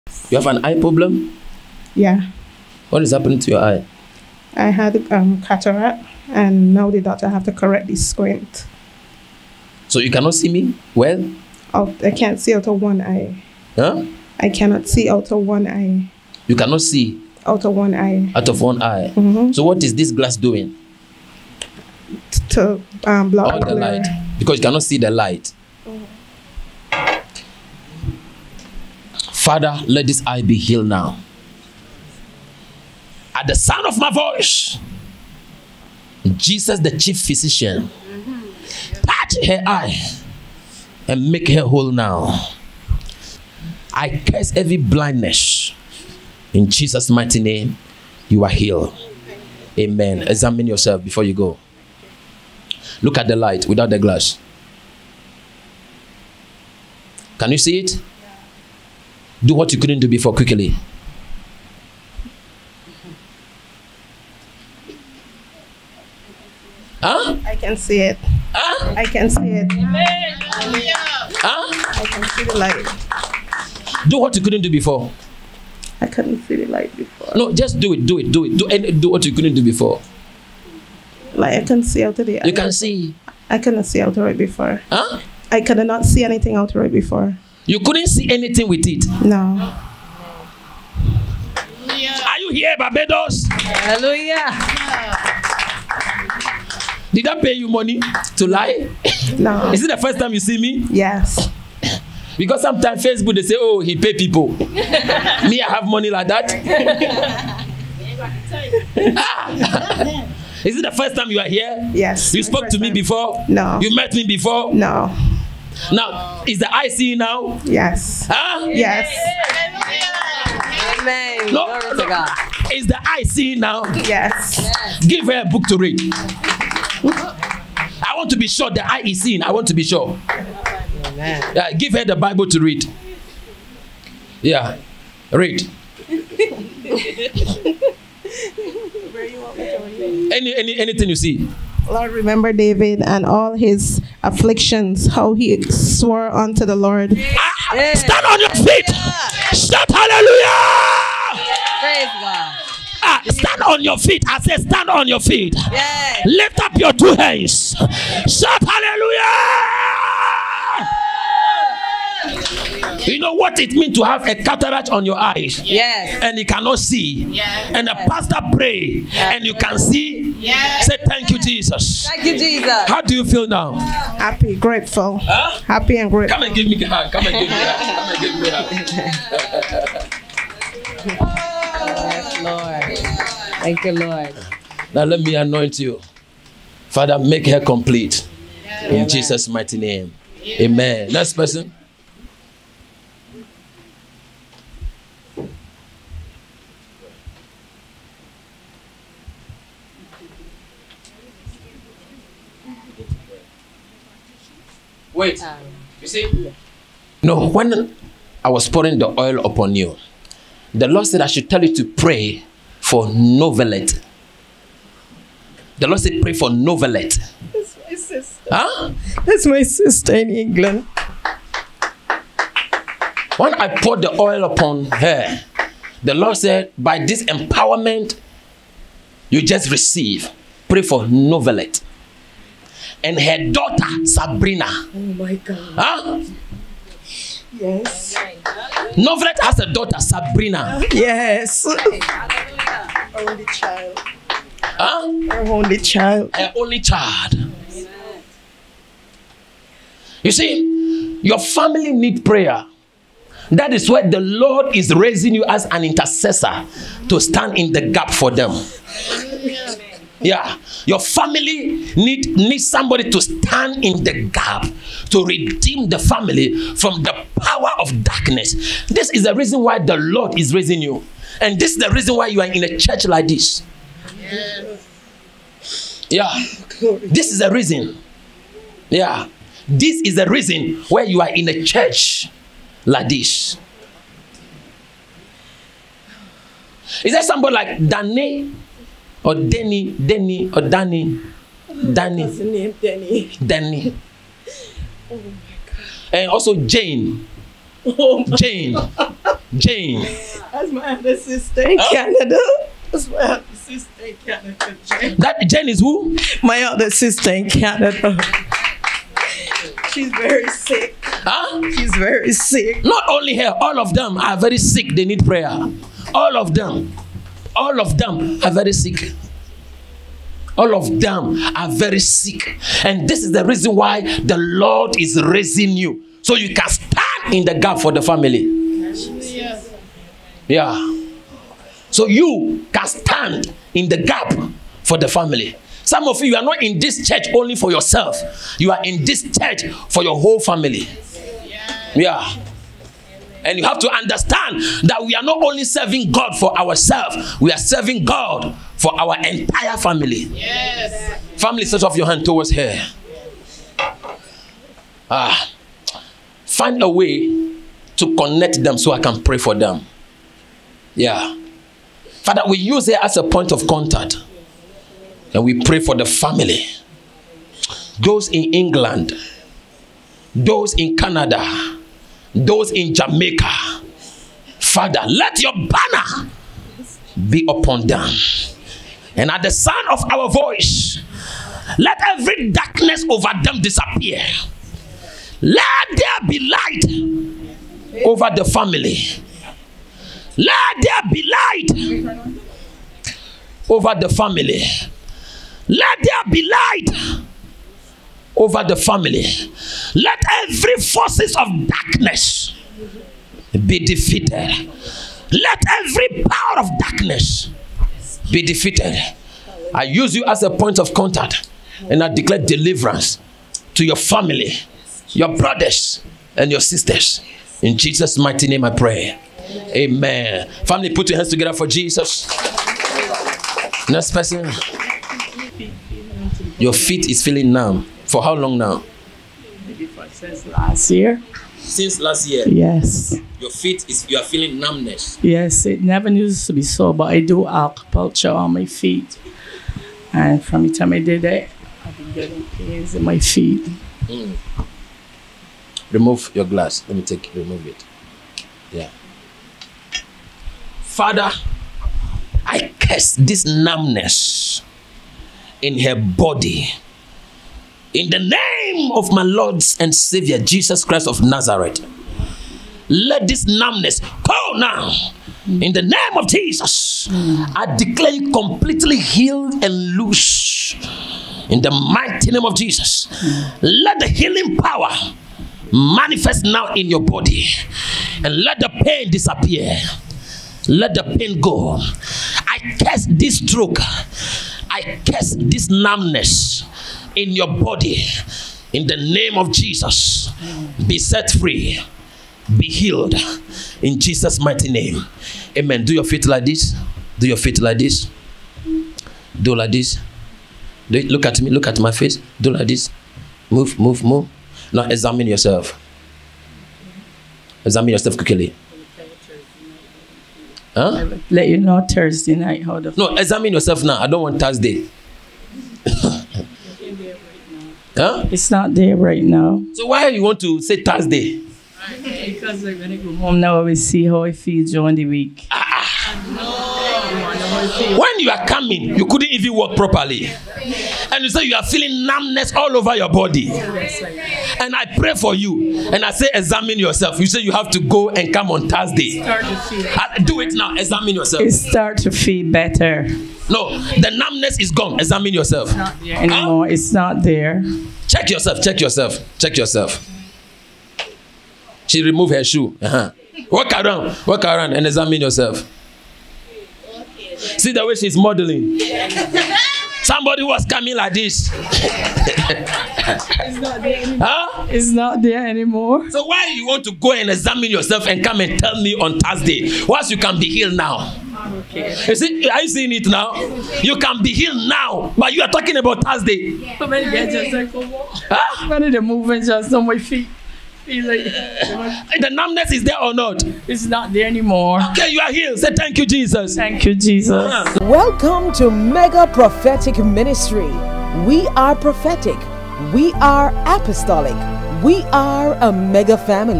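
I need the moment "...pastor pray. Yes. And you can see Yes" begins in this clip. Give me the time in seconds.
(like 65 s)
168 s.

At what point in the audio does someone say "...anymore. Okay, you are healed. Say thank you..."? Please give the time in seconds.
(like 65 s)
584 s.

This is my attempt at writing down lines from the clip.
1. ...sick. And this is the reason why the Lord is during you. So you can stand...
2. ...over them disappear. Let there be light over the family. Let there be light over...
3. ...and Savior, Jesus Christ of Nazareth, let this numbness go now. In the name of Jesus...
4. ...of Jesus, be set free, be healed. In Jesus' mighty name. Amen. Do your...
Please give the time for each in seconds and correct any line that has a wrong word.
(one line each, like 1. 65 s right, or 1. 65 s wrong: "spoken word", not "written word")
1. 321 s wrong: "raising", not "during"
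2. 383 s right
3. 459 s right
4. 489 s right.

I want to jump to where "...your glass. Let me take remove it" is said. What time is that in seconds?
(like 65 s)
446 s.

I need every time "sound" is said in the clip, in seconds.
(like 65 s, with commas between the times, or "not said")
33 s, 379 s.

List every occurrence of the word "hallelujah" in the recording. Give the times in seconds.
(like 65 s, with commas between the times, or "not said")
93 s, 149 s, 158 s.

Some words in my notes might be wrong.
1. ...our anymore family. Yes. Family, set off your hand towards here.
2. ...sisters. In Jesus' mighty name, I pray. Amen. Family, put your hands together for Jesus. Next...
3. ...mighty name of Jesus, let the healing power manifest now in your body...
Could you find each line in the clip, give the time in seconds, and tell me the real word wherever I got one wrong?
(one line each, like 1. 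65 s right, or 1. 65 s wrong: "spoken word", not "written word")
1. 348 s wrong: "entire", not "anymore"
2. 416 s right
3. 471 s right.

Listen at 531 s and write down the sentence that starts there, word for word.
and you say you are feeling numbness all over your body.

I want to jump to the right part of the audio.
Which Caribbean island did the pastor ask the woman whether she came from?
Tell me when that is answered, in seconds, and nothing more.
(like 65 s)
92 s.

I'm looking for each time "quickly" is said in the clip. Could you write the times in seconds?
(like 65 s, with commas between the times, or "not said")
60 s, 508 s.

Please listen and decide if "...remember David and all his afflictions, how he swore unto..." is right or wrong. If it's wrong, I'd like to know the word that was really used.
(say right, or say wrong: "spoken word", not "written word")
right.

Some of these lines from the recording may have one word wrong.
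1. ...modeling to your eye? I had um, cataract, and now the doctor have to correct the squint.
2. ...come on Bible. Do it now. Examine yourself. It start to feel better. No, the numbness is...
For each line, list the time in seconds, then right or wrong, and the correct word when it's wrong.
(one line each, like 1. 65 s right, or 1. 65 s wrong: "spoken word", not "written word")
1. 3 s wrong: "happening", not "modeling"
2. 538 s wrong: "Thursday", not "Bible".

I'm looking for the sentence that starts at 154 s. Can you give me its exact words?
I say, stand on your feet.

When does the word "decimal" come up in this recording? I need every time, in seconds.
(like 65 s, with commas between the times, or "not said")
not said.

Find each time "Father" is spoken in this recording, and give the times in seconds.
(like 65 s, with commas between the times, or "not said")
29 s, 186 s, 362 s, 374 s, 450 s.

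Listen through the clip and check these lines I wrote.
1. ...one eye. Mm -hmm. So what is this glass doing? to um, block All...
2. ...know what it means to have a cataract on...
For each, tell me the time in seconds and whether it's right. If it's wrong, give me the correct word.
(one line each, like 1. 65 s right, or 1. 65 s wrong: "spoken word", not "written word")
1. 18 s right
2. 163 s right.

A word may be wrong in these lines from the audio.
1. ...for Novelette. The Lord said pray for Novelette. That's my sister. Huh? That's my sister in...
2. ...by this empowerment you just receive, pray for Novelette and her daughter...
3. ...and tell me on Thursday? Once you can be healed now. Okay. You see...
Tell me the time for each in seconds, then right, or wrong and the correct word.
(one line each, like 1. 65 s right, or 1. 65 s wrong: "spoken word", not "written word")
1. 212 s right
2. 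226 s right
3. 568 s right.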